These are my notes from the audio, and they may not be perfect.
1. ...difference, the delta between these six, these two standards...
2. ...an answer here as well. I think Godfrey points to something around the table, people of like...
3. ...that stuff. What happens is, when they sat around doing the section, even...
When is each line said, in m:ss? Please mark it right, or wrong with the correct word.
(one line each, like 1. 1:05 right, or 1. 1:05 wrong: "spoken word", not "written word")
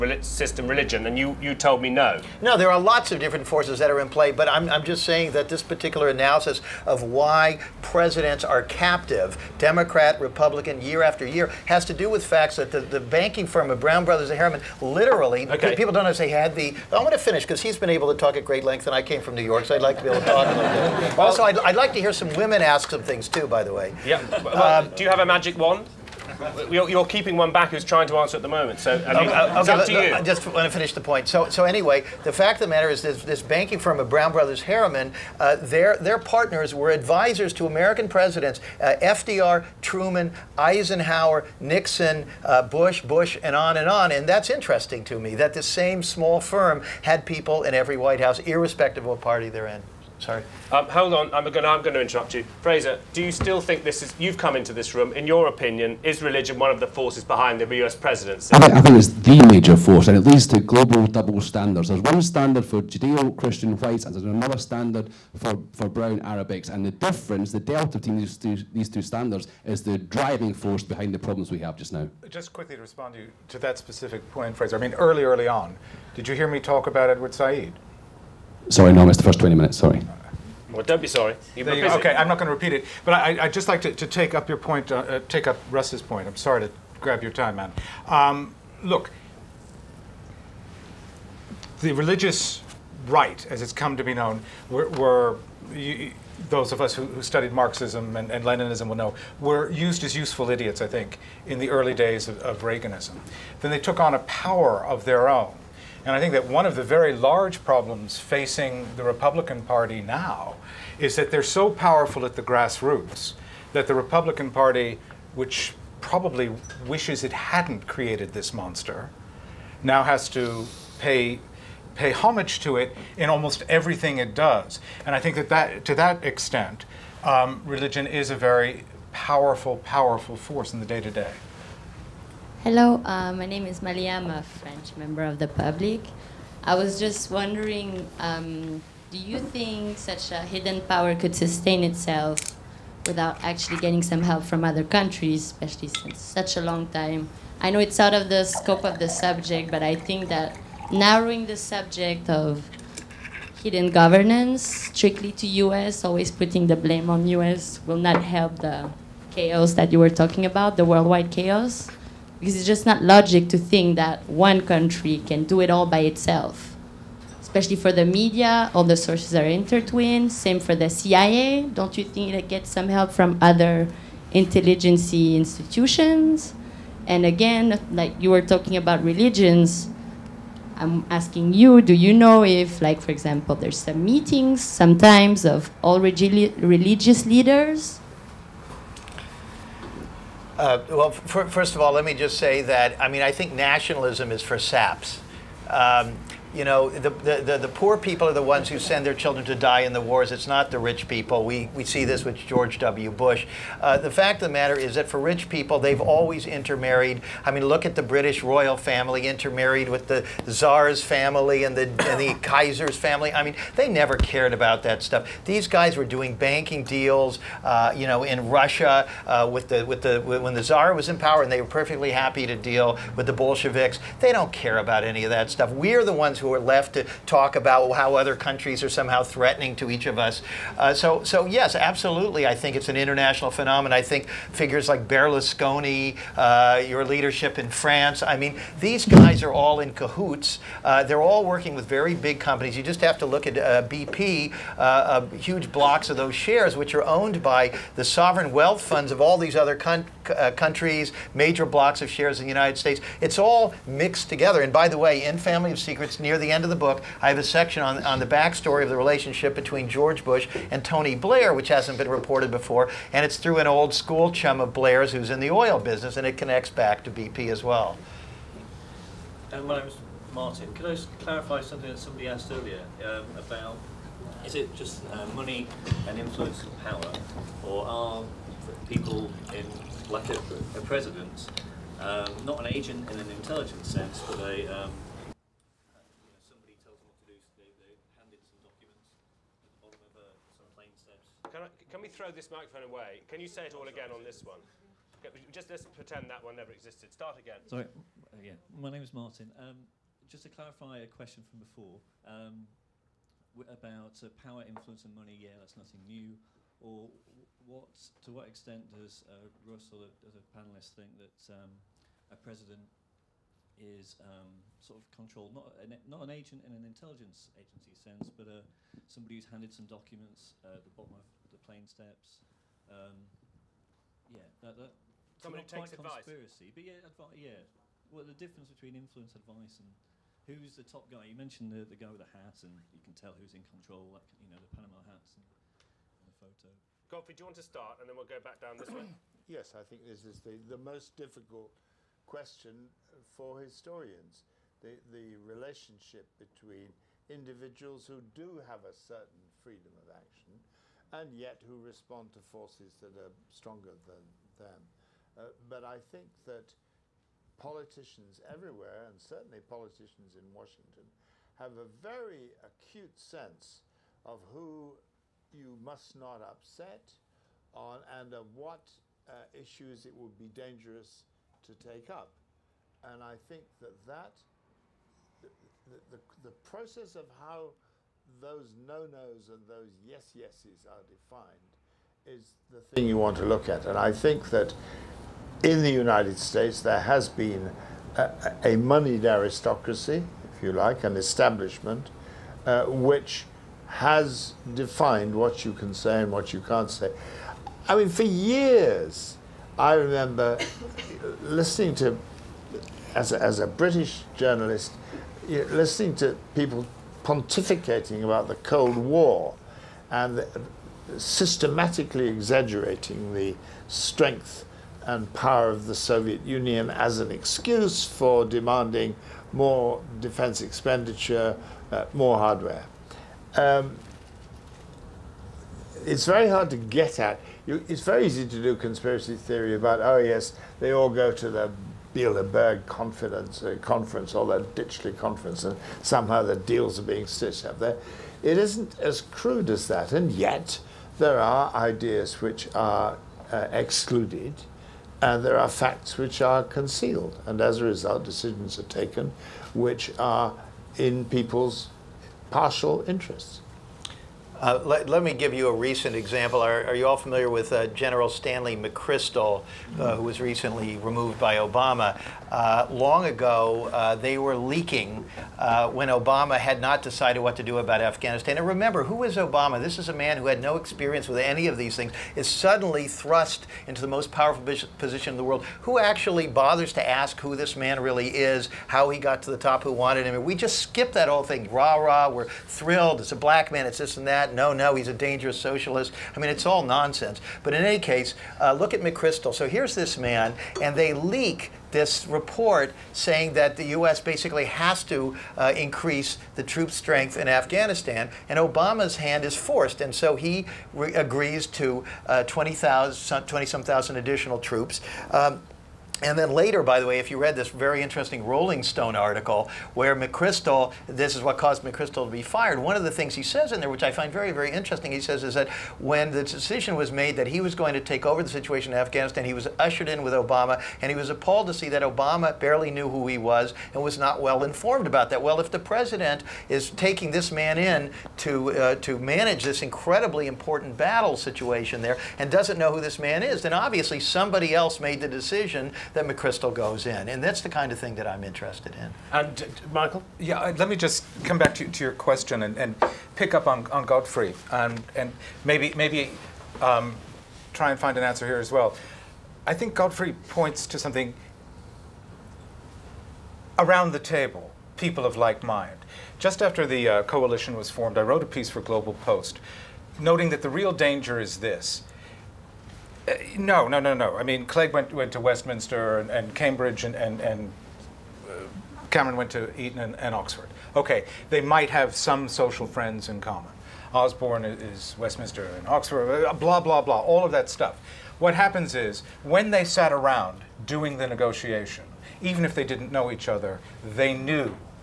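1. 1:06 wrong: "two", not "six"
2. 9:08 right
3. 9:37 wrong: "negotiation", not "section".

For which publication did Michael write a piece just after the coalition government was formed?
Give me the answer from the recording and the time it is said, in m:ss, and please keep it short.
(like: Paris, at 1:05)
Global Post, at 9:18.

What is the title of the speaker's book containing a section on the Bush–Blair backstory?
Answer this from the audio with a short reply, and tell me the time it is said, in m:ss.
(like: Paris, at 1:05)
Family of Secrets, at 4:15.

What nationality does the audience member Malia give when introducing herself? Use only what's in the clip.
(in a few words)
French.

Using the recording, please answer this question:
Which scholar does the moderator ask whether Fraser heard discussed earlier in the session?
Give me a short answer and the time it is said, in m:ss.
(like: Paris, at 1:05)
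Edward Said, at 1:17.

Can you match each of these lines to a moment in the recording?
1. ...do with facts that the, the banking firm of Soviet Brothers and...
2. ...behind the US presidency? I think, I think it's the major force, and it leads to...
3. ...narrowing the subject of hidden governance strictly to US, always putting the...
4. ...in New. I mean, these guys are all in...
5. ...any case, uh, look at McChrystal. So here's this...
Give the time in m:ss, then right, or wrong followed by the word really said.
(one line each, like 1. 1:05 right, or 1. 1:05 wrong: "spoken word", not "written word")
1. 0:11 wrong: "Brown", not "Soviet"
2. 0:57 right
3. 2:30 right
4. 3:57 wrong: "France", not "New"
5. 8:07 right.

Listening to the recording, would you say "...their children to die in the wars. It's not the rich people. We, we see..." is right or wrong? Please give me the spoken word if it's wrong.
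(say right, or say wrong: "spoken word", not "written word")
right.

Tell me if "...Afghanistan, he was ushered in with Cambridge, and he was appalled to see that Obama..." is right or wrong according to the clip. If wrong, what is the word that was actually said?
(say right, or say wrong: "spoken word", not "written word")
wrong: "Obama", not "Cambridge".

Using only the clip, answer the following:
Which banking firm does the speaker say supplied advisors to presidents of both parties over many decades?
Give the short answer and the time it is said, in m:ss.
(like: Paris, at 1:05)
Brown Brothers Harriman, at 0:34.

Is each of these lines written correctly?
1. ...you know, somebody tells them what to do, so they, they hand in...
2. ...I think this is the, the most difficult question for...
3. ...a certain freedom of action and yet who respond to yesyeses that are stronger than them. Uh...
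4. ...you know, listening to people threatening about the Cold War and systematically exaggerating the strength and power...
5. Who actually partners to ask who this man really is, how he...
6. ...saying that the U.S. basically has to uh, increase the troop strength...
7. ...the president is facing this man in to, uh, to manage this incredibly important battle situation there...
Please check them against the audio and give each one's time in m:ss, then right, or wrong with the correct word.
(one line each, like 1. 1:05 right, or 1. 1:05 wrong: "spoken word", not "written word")
1. 4:46 right
2. 5:39 right
3. 5:48 wrong: "forces", not "yesyeses"
4. 6:45 wrong: "pontificating", not "threatening"
5. 7:55 wrong: "bothers", not "partners"
6. 8:13 right
7. 8:45 wrong: "taking", not "facing".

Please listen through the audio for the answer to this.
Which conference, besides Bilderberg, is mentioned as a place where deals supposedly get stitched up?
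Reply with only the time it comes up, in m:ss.
7:14.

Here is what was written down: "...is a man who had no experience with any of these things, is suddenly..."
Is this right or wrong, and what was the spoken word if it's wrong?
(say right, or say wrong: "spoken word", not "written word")
right.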